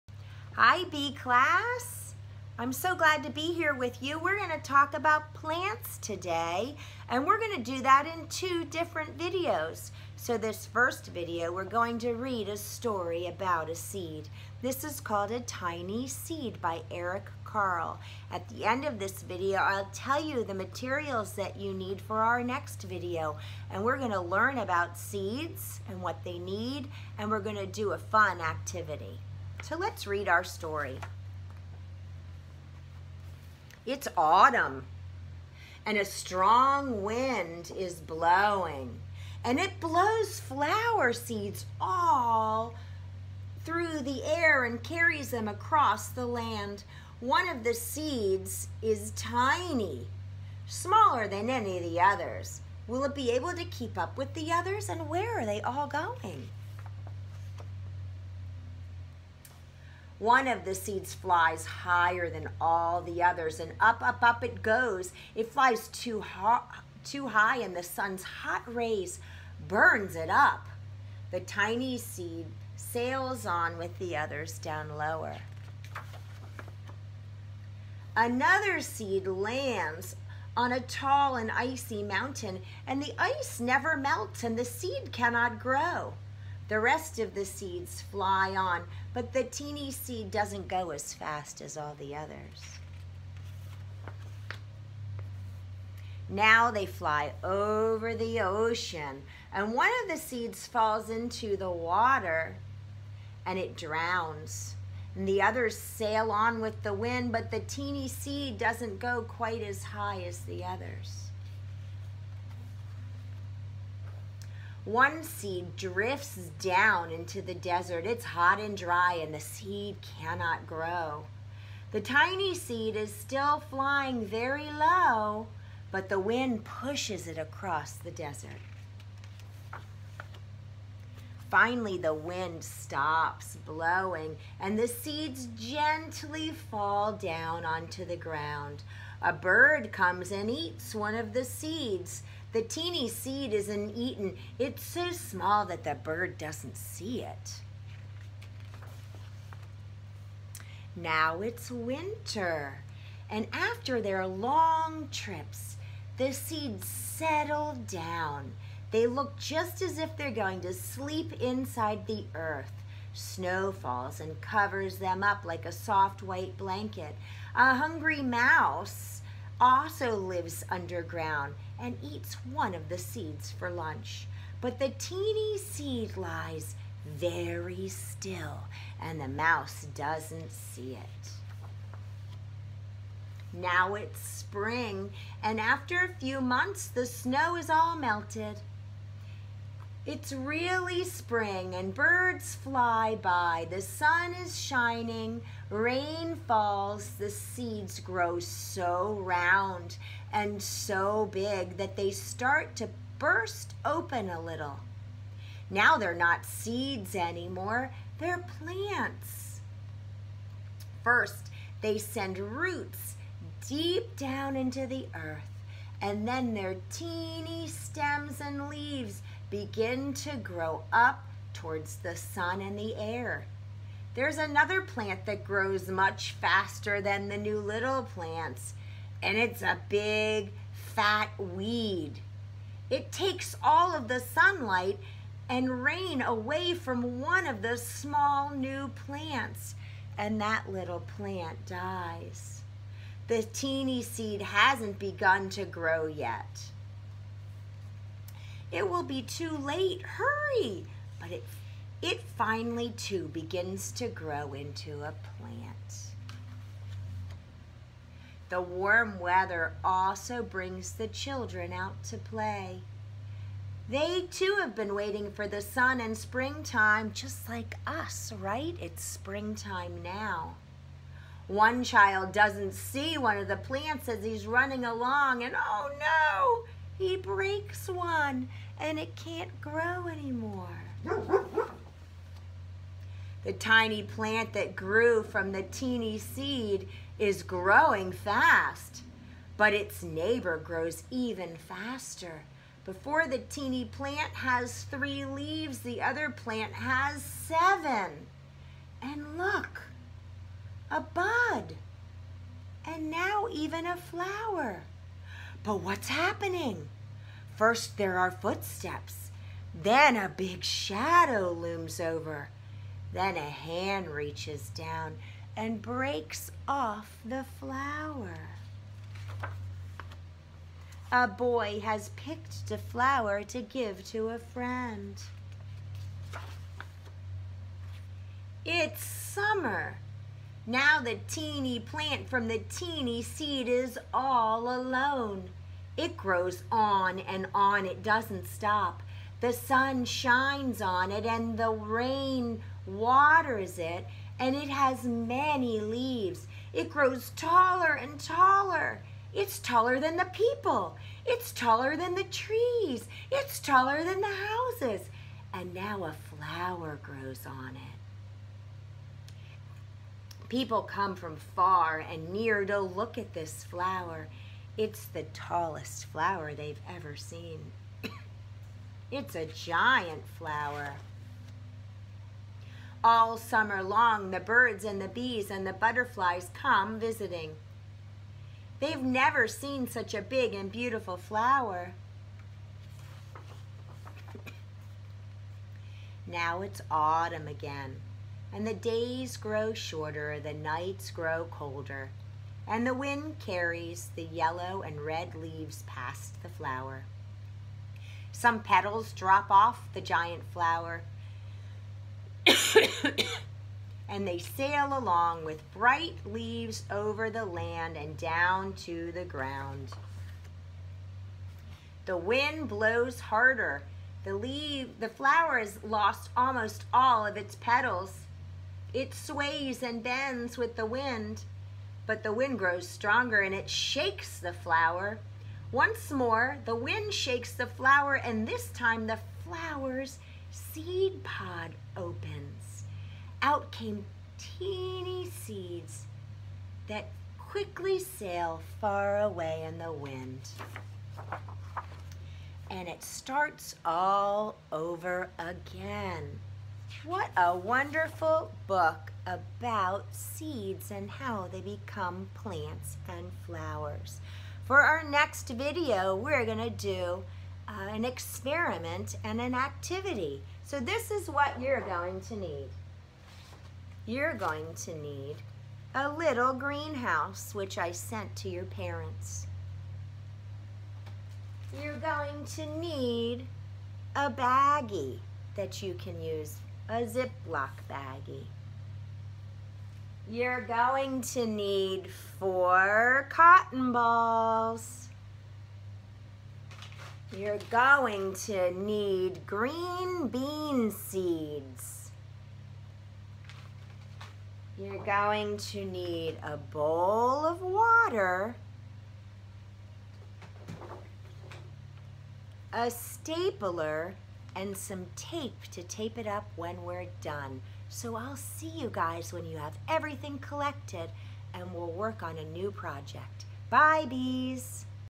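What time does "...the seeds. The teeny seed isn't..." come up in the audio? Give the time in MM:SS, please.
02:21.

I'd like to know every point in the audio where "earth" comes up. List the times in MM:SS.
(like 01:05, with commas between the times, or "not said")
02:42, 03:35.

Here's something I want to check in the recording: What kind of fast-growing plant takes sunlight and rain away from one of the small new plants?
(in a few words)
A big, fat weed.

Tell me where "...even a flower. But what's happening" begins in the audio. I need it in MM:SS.
05:03.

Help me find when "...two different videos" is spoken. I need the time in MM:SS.
00:08.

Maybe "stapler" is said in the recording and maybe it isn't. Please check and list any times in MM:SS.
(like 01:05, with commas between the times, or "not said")
08:22.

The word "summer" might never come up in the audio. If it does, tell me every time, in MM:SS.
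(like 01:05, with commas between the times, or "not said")
05:29, 06:13.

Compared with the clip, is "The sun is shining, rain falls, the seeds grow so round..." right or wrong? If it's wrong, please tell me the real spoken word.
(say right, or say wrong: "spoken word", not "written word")
right.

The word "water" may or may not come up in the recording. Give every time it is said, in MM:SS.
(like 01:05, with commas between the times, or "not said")
01:41, 05:42, 08:17.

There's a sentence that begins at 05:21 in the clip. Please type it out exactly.
A boy has picked a flower to give to a friend.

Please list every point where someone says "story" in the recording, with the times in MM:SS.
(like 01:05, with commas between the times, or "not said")
00:12, 00:30.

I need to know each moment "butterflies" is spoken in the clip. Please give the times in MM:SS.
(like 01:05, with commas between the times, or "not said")
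06:15.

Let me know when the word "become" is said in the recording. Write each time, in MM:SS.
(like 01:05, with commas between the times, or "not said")
07:31.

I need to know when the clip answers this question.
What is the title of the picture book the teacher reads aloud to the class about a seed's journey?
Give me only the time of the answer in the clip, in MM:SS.
00:15.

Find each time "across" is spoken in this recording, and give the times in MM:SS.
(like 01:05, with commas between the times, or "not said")
00:45, 02:07.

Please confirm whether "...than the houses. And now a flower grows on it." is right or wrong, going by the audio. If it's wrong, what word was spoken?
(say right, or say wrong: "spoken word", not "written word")
right.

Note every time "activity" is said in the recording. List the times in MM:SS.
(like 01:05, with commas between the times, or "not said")
00:28, 07:39.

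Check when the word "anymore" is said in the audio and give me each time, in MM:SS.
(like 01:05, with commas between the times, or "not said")
03:27, 04:40.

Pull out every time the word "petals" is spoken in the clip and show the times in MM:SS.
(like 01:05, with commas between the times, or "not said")
06:38, 06:57.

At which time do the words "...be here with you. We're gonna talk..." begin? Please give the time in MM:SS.
00:03.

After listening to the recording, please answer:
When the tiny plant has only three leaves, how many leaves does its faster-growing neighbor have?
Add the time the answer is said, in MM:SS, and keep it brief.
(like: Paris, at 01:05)
7, at 04:57.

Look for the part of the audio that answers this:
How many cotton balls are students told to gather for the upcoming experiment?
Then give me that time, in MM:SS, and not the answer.
08:02.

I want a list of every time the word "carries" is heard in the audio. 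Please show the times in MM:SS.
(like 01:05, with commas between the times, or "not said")
00:44, 06:33.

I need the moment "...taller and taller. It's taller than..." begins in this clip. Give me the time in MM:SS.
05:47.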